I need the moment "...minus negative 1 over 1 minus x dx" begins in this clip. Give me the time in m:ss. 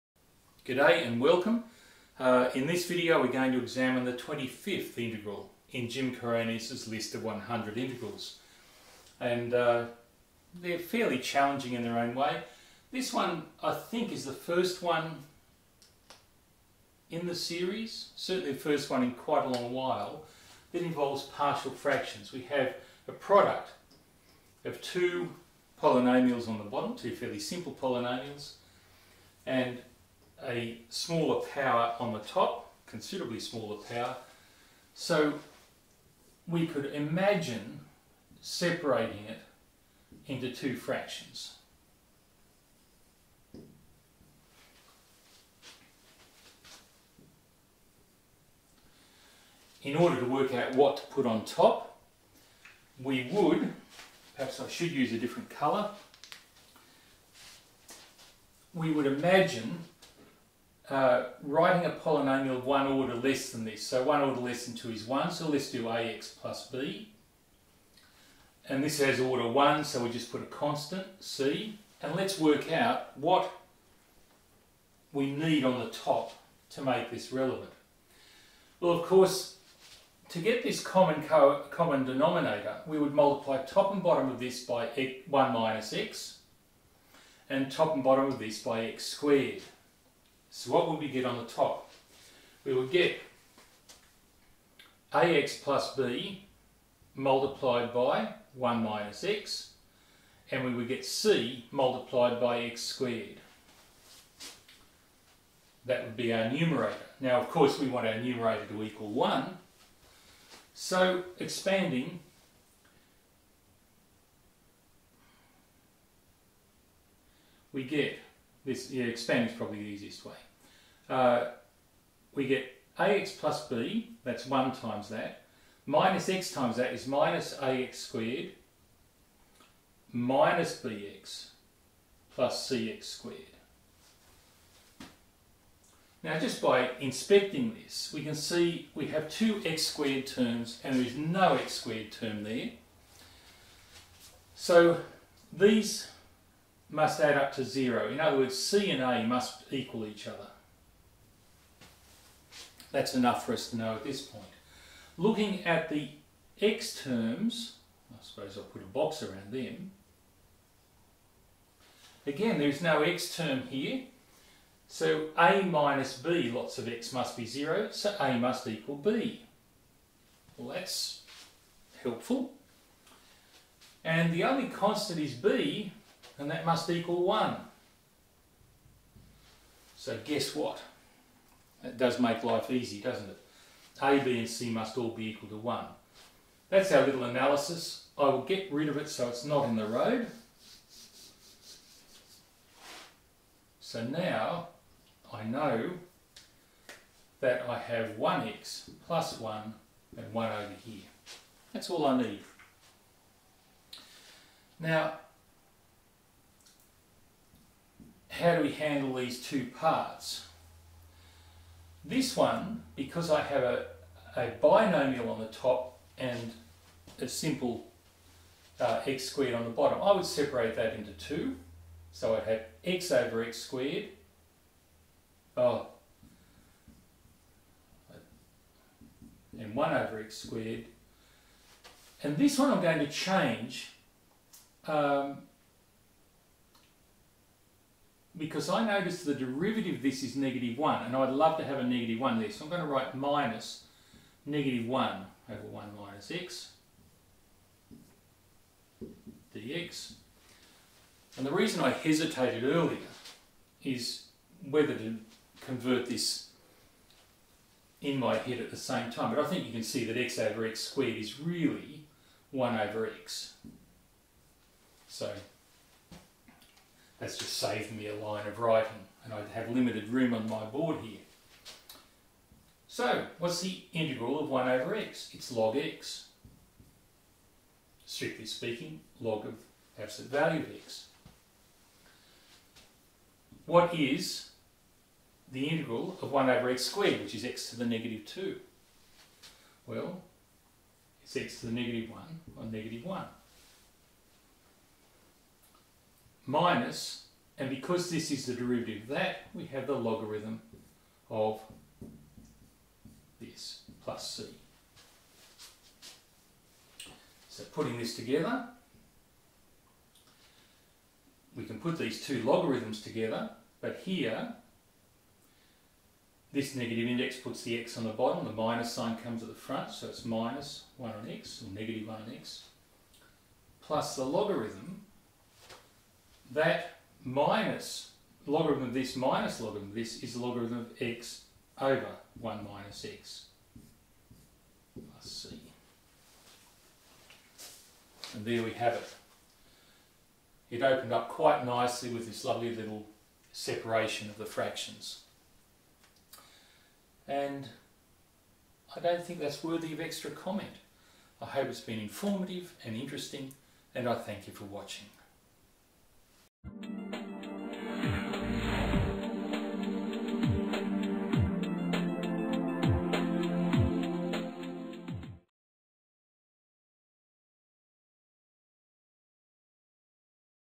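4:03.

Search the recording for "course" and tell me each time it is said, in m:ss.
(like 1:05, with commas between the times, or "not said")
1:19, 1:47.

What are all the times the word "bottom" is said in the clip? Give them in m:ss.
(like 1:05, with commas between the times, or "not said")
0:26, 1:24, 1:28, 3:39, 5:18.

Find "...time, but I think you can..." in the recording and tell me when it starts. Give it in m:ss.
4:19.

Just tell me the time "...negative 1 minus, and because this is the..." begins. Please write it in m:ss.
4:52.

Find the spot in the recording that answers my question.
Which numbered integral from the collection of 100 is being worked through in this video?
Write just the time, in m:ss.
0:04.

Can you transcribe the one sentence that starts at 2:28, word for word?
In other words, C and A must equal each other.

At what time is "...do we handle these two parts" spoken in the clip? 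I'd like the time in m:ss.
3:28.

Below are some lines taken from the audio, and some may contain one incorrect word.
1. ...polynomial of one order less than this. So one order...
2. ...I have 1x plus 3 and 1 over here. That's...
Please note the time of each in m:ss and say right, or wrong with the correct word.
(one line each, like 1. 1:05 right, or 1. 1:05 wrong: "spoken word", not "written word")
1. 1:01 right
2. 3:17 wrong: "1", not "3".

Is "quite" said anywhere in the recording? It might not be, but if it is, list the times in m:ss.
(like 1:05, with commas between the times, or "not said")
0:19, 5:41.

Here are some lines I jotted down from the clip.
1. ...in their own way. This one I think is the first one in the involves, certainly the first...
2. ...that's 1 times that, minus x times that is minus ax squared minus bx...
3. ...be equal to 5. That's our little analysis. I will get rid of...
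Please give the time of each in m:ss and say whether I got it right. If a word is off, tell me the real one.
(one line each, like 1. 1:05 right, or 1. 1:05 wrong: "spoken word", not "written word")
1. 0:11 wrong: "series", not "involves"
2. 2:04 right
3. 3:05 wrong: "1", not "5".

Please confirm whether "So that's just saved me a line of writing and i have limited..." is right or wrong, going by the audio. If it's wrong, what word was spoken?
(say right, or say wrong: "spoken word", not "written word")
right.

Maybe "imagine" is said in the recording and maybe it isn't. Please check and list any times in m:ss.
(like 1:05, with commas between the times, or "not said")
0:36, 0:59.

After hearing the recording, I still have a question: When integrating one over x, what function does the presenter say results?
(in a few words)
log x.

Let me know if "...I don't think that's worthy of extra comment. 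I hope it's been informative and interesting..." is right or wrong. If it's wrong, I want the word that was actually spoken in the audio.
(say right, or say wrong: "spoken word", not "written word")
right.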